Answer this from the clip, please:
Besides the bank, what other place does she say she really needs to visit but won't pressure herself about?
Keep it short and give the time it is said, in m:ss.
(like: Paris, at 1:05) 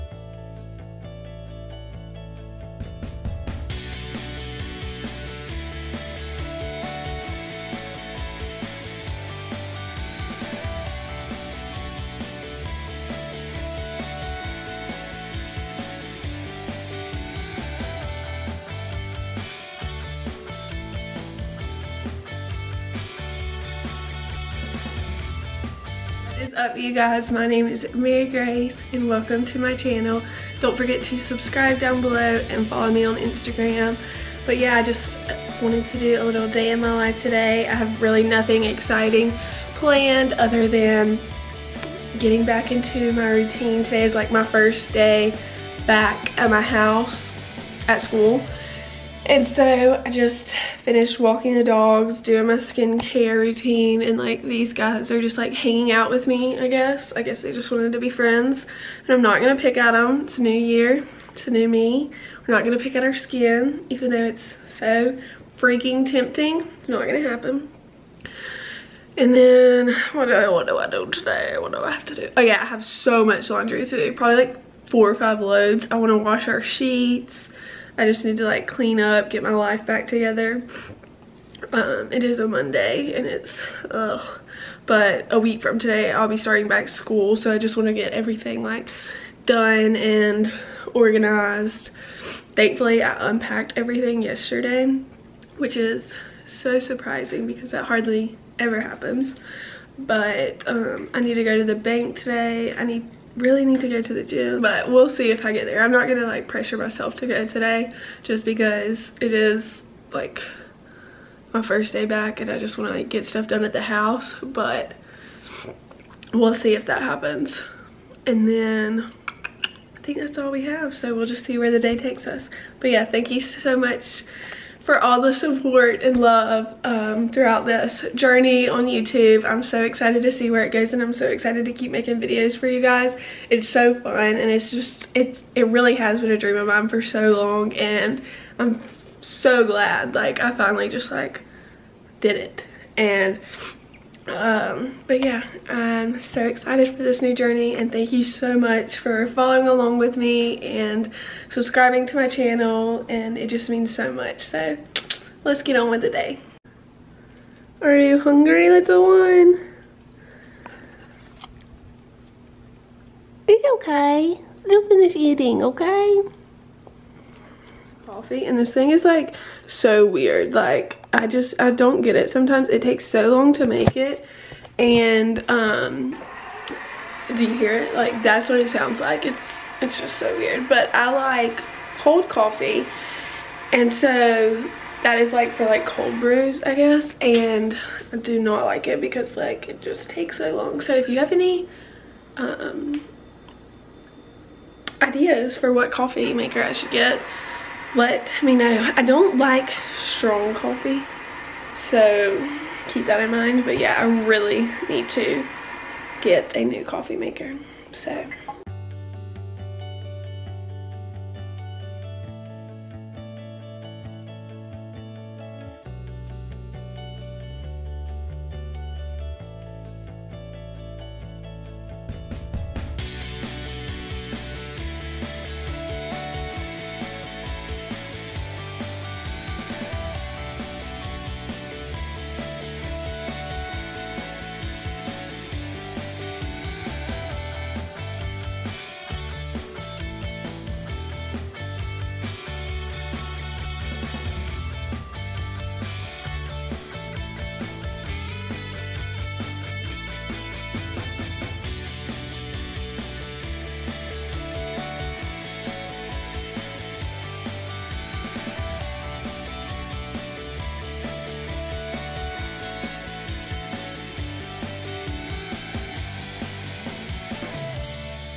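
the gym, at 1:44.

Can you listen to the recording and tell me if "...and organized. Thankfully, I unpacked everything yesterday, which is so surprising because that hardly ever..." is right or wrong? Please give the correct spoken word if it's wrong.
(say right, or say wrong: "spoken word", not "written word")
right.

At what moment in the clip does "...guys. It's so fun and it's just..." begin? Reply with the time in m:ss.
2:12.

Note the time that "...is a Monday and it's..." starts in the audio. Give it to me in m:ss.
1:22.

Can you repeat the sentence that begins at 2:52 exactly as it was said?
Sometimes it takes so long to make it.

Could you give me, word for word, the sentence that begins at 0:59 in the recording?
And I'm not gonna pick at them.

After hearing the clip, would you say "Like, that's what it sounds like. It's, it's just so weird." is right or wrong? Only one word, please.
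right.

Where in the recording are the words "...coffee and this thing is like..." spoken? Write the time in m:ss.
2:48.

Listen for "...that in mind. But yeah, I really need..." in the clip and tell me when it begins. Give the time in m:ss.
3:23.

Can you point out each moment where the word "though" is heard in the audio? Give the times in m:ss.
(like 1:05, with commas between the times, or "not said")
1:04.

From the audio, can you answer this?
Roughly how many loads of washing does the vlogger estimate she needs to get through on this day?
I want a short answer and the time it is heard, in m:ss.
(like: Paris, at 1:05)
4 or 5, at 1:14.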